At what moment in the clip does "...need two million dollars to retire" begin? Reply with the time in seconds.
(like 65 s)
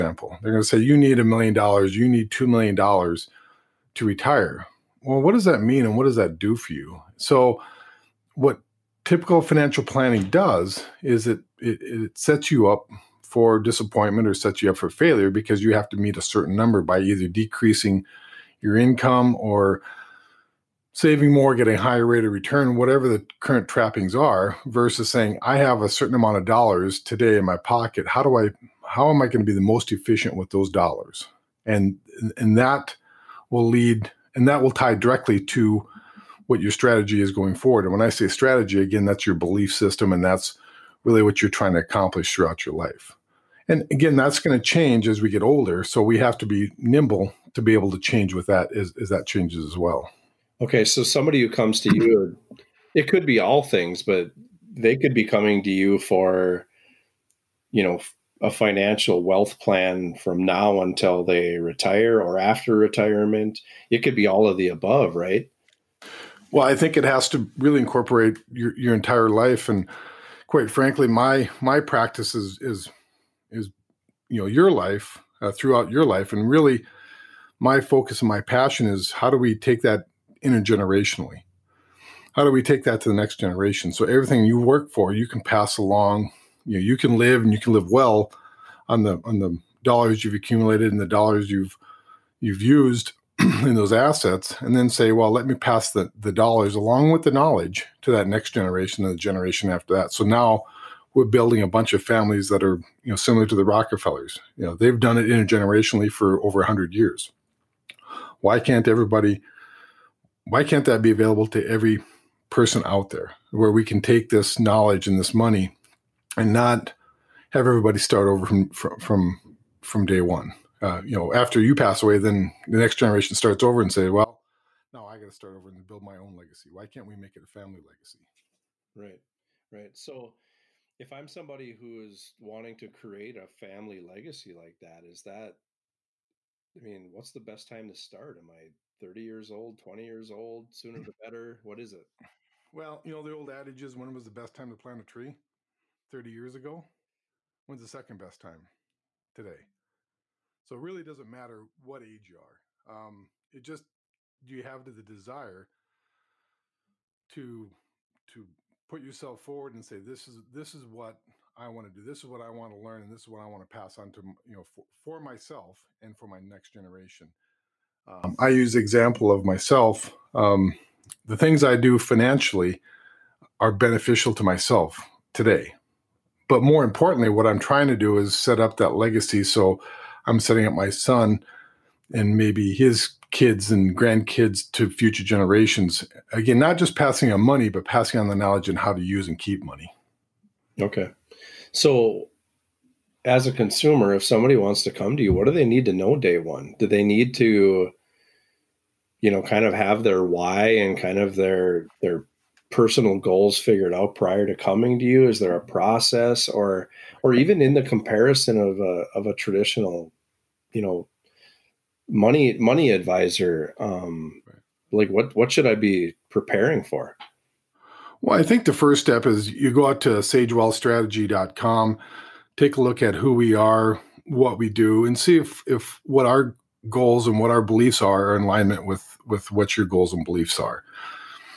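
2 s.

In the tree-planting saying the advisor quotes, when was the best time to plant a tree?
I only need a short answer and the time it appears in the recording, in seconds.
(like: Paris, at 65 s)
30 years ago, at 146 s.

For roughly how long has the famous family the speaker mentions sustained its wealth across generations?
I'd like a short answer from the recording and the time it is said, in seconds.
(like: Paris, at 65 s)
over 100 years, at 106 s.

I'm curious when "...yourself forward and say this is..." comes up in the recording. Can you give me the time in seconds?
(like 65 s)
159 s.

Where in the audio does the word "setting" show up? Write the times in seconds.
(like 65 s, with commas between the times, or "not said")
180 s.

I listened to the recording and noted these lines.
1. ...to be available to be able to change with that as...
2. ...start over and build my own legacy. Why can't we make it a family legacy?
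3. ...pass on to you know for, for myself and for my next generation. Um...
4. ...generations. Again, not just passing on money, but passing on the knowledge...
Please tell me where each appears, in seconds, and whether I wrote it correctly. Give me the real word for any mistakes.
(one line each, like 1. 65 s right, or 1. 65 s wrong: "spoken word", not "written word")
1. 46 s wrong: "nimble", not "available"
2. 125 s right
3. 163 s right
4. 185 s right.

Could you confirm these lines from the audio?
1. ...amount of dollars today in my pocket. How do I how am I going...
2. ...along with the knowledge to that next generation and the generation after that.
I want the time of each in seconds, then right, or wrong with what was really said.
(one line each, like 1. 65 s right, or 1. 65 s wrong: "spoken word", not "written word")
1. 26 s right
2. 96 s right.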